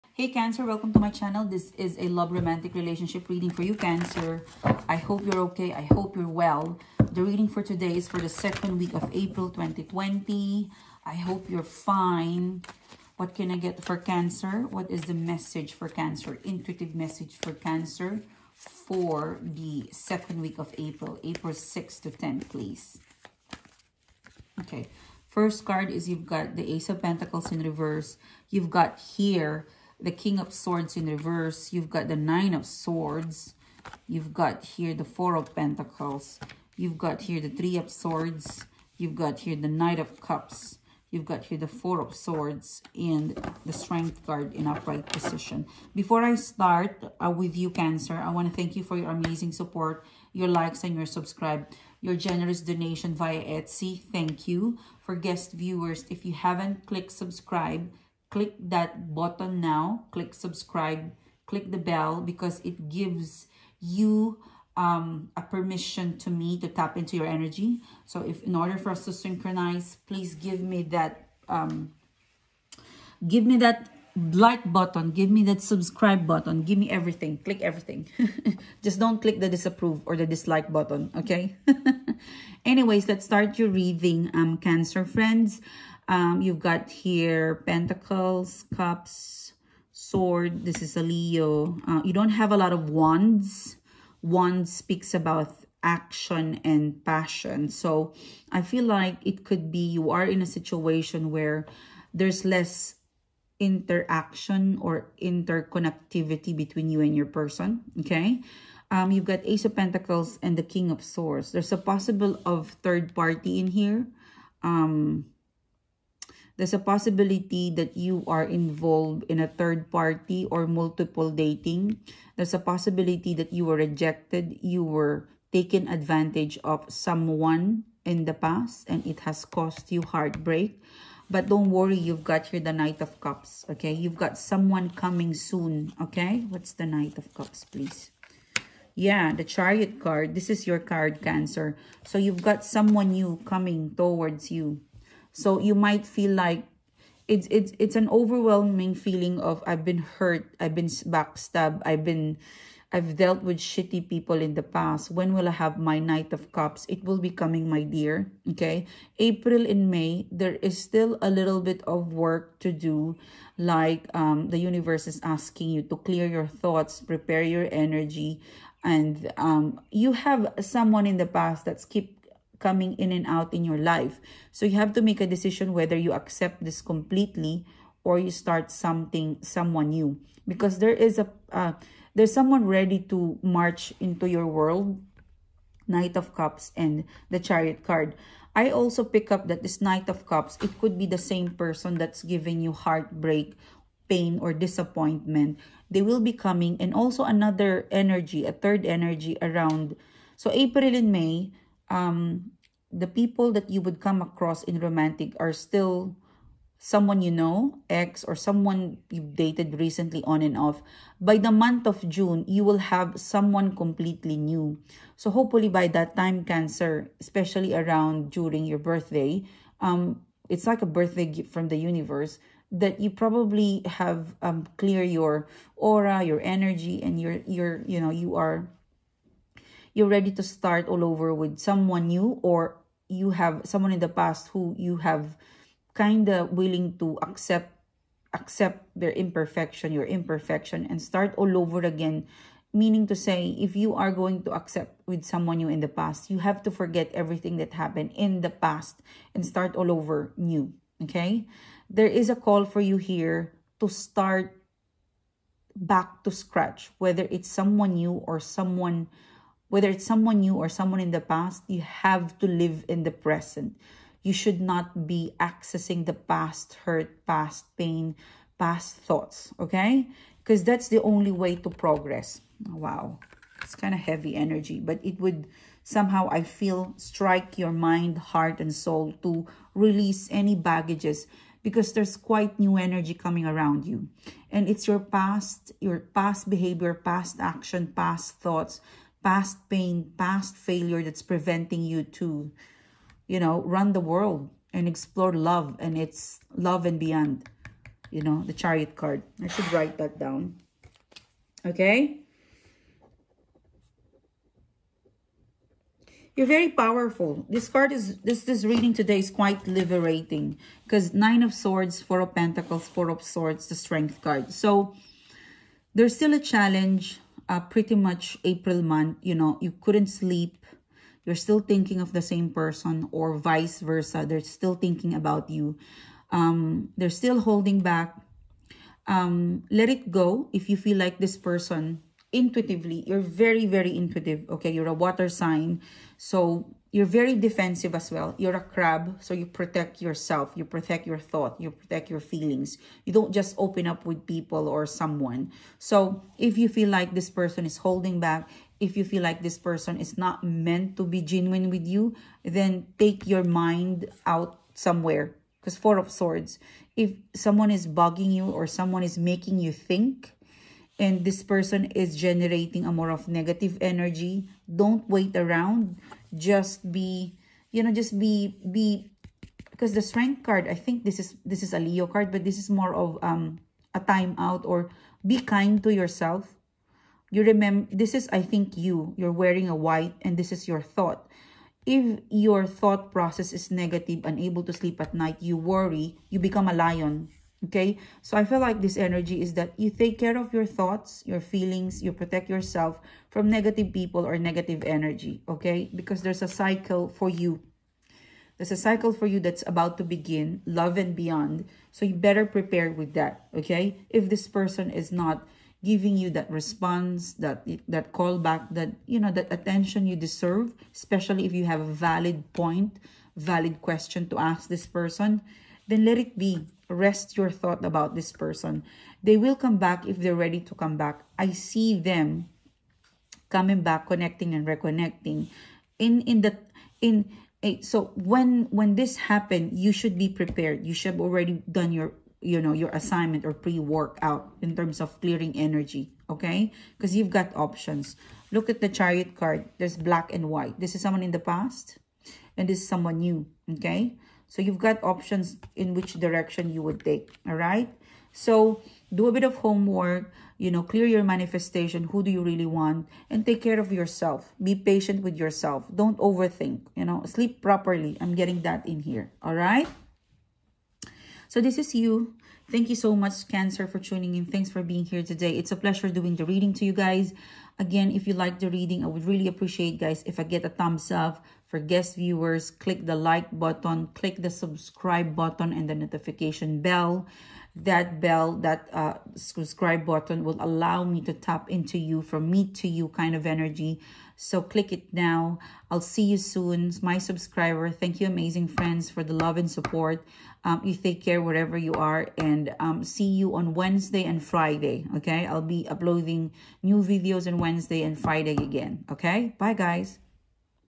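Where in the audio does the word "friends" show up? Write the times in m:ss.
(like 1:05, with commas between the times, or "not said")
1:25, 8:08.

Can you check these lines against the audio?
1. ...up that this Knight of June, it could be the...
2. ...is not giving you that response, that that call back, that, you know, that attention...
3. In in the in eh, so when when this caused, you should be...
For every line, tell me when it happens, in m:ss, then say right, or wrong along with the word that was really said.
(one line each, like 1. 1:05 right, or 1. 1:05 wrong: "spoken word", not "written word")
1. 3:09 wrong: "Cups", not "June"
2. 6:44 right
3. 7:05 wrong: "happened", not "caused".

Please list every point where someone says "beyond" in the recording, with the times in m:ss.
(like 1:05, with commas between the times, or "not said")
4:56, 6:41.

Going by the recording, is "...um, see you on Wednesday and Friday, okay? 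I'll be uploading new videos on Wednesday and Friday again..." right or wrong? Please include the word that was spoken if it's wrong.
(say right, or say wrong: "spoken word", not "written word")
right.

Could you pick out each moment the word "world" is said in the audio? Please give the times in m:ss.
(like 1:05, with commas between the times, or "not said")
3:04, 4:54.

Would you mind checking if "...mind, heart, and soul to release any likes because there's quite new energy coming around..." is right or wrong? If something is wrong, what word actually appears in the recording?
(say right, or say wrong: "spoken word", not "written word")
wrong: "baggages", not "likes".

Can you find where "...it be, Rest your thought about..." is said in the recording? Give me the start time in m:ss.
6:56.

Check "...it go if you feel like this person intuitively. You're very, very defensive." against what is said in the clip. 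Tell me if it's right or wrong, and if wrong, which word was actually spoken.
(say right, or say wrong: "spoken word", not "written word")
wrong: "intuitive", not "defensive".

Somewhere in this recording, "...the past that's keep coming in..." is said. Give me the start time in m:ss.
2:51.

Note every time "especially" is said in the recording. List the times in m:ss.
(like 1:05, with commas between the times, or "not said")
3:37, 6:50.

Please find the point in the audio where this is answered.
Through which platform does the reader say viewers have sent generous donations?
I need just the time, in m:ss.
0:53.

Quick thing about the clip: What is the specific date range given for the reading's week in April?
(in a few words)
April 6th to 10th.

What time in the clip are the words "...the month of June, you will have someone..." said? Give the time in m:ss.
3:31.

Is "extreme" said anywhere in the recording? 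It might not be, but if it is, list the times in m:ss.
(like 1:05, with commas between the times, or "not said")
not said.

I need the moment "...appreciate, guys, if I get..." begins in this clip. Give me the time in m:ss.
7:49.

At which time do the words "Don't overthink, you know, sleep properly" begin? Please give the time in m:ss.
7:35.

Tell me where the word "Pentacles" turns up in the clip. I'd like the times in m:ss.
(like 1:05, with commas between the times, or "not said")
0:27, 0:35, 1:27, 1:49, 5:12.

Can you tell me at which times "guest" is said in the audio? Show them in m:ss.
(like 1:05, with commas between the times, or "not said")
0:55, 7:51.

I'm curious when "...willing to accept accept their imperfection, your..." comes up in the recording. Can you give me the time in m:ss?
3:56.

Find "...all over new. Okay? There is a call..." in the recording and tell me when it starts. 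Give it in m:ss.
4:09.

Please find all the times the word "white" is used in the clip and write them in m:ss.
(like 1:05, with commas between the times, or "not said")
6:19, 7:20.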